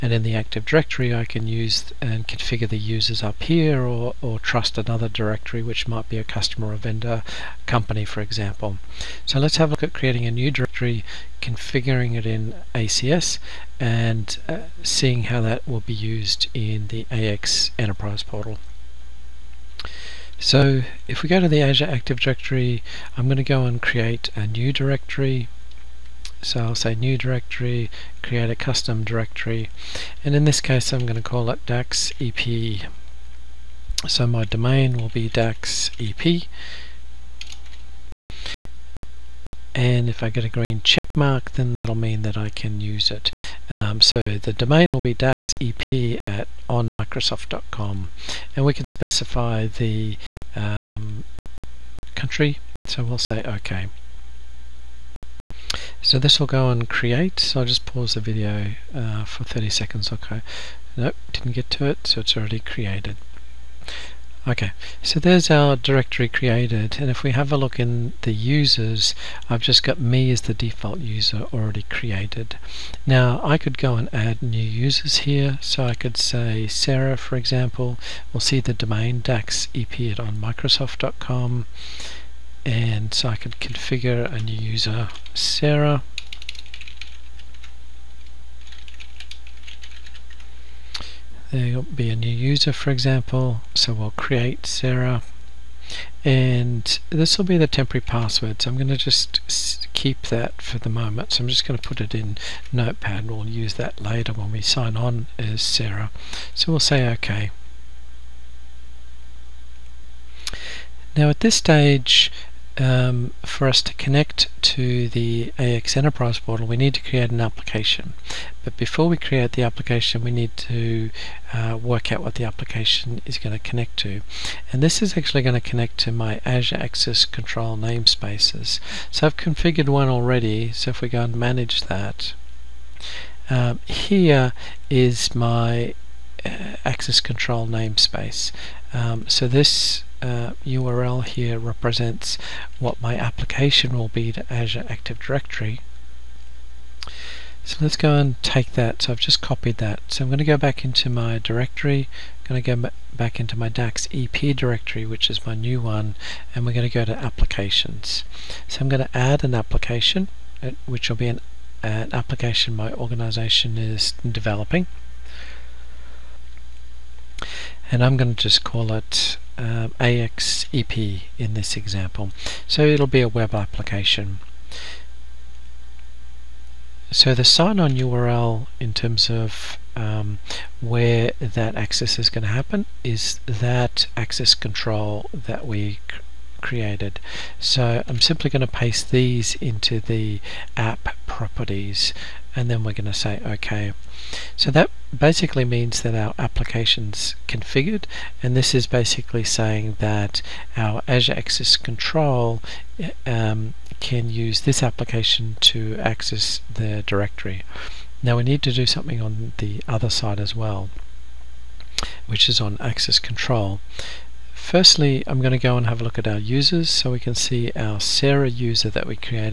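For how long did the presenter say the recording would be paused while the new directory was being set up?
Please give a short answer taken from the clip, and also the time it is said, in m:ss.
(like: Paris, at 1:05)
30 seconds, at 0:59.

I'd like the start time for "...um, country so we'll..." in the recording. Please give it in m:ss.
0:50.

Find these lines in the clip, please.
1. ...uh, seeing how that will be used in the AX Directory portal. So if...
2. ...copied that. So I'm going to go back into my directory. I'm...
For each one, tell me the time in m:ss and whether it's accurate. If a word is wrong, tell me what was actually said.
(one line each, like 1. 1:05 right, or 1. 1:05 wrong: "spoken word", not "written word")
1. 0:14 wrong: "Enterprise", not "Directory"
2. 2:29 right.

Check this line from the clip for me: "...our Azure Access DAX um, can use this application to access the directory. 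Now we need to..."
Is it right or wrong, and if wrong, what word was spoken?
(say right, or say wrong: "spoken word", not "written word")
wrong: "Control", not "DAX".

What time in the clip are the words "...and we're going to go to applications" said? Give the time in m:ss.
2:36.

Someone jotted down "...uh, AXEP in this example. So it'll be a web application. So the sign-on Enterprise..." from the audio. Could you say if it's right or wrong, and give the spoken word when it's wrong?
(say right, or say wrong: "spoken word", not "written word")
wrong: "URL", not "Enterprise".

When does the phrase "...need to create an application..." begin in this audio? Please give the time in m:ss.
1:56.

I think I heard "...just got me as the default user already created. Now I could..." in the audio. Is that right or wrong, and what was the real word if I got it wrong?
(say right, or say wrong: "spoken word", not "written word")
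right.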